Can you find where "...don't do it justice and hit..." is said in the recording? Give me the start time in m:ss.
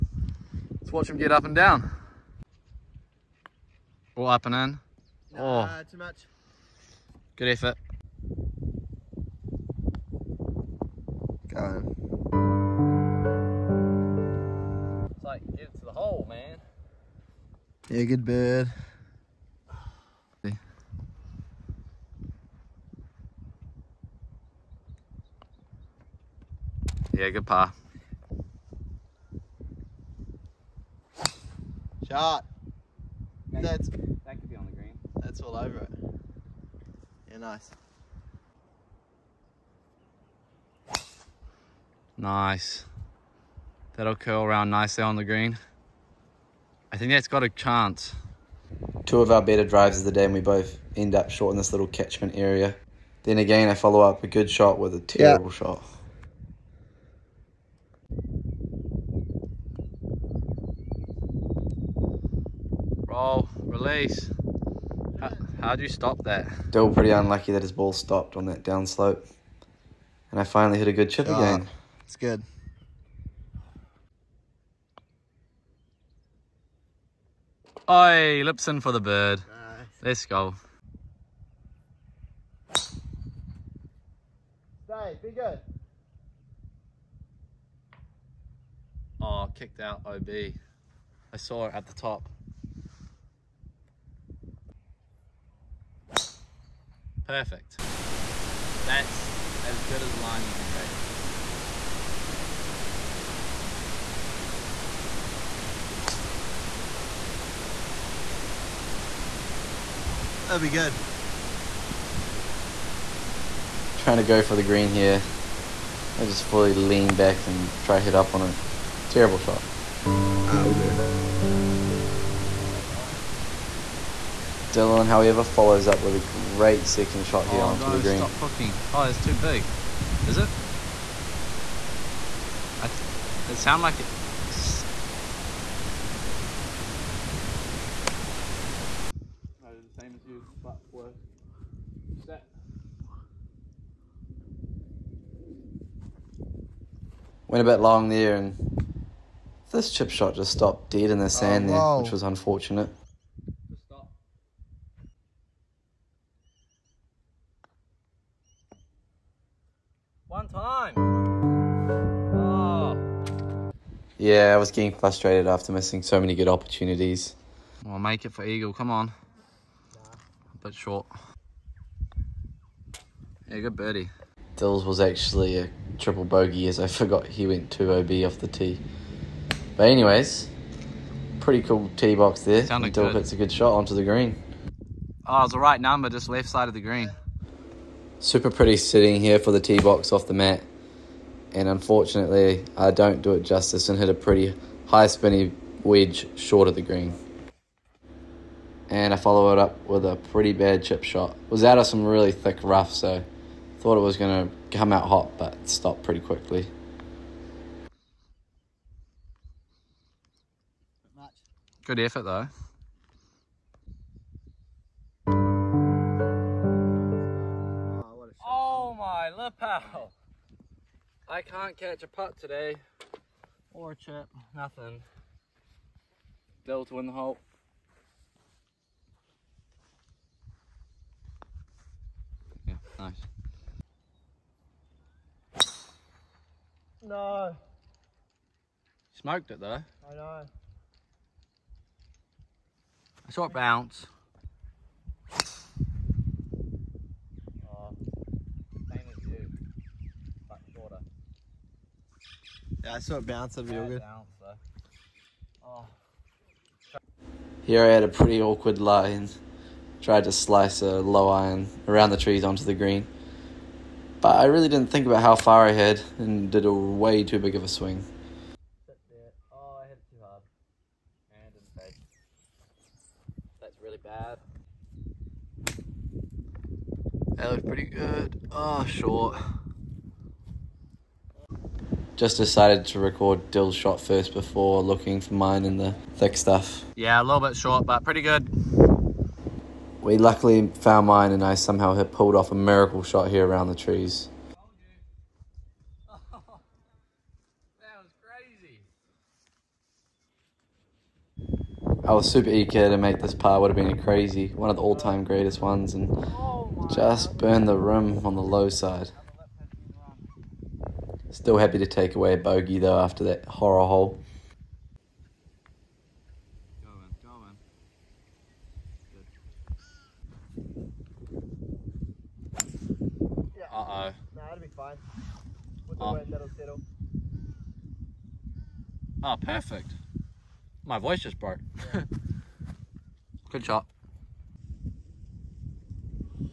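3:12.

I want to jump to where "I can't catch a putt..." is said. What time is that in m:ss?
3:41.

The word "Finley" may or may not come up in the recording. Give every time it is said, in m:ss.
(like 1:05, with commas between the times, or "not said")
not said.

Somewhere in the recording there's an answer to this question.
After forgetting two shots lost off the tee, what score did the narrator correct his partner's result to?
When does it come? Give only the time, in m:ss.
2:55.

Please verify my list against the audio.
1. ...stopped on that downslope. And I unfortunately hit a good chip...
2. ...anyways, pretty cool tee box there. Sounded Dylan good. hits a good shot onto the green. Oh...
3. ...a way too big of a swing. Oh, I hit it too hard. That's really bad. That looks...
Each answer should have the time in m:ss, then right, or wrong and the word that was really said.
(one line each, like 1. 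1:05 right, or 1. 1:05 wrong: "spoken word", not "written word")
1. 1:07 wrong: "finally", not "unfortunately"
2. 2:59 wrong: "Dill", not "Dylan"
3. 4:26 right.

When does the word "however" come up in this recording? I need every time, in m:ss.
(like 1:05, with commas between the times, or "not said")
2:05.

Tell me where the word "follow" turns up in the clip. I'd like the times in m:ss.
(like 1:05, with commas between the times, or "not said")
0:53, 2:05, 3:19.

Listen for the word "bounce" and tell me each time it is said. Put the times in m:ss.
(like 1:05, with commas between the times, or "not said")
4:03, 4:13.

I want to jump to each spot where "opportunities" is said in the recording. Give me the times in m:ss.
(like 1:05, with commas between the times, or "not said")
2:46.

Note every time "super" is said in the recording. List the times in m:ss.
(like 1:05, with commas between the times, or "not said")
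3:08, 5:02.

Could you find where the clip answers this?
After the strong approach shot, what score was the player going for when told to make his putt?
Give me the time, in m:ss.
2:48.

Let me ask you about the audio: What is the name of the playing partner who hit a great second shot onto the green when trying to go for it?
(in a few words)
Dylan.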